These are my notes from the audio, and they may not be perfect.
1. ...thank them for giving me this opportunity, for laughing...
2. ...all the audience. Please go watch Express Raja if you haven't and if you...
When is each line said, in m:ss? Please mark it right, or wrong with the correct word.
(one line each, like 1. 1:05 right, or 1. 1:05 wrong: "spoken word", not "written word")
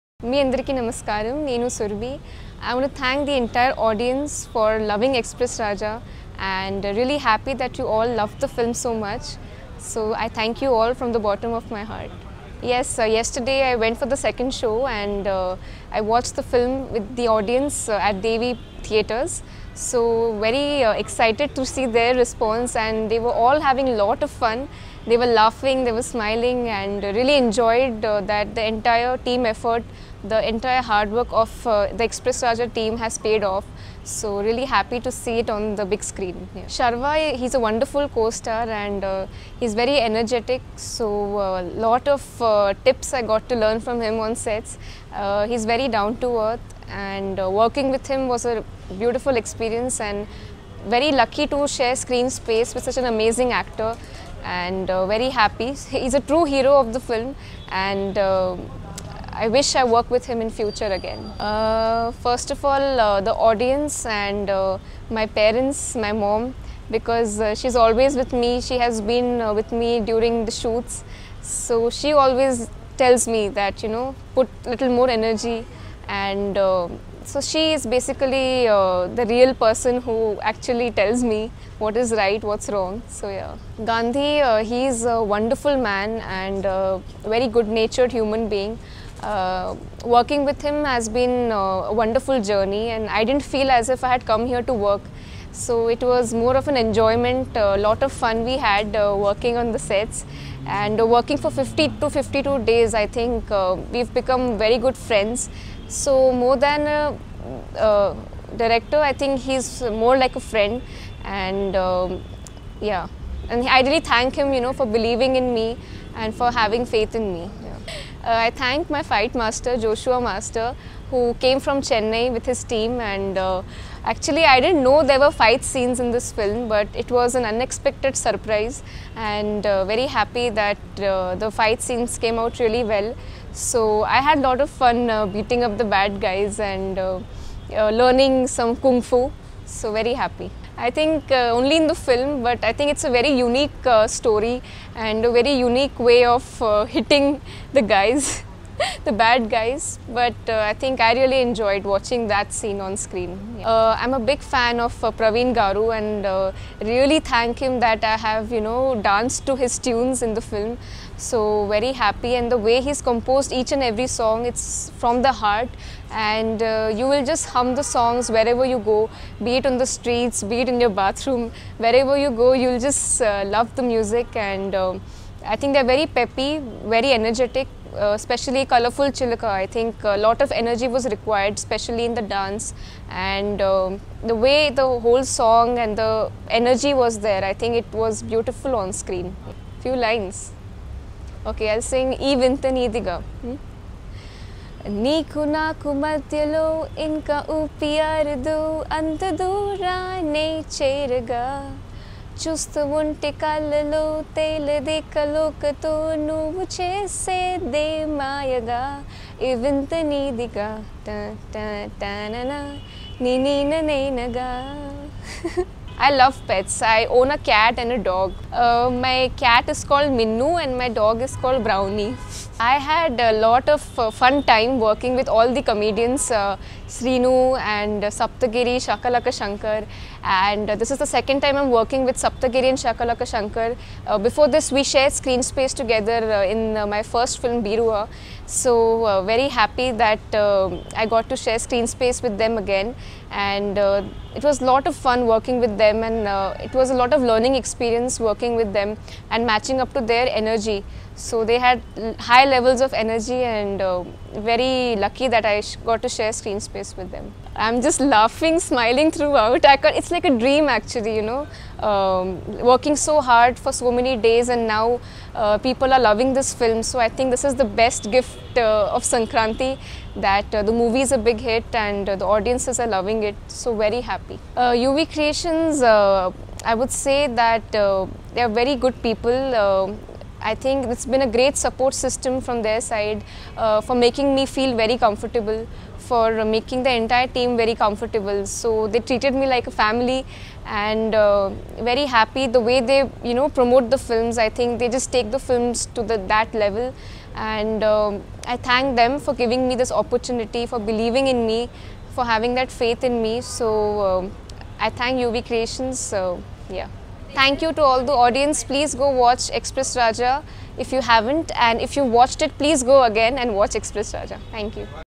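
1. 4:58 wrong: "believing", not "laughing"
2. 5:07 right.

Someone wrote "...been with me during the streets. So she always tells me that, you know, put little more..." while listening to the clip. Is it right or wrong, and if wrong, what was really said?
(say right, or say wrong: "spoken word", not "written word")
wrong: "shoots", not "streets".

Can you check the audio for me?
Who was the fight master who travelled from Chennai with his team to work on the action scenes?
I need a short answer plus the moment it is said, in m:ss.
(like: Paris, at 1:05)
Joshua Master, at 1:59.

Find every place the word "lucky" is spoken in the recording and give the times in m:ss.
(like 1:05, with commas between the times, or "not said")
0:51, 4:14.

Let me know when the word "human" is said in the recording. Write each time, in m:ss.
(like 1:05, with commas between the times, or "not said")
1:28.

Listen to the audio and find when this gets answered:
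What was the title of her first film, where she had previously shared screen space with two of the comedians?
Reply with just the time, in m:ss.
3:57.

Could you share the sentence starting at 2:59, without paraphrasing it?
I think a lot of energy was required, especially in the dance.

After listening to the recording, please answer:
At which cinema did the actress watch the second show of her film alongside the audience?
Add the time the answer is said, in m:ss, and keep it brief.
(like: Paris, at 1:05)
Devi Theatres, at 0:18.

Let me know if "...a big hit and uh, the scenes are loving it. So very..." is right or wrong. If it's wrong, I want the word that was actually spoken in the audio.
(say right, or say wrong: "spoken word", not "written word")
wrong: "audiences", not "scenes".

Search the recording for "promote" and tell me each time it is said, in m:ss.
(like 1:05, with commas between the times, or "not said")
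4:53.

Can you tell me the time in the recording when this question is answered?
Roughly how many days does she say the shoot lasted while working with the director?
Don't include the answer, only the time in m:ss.
1:41.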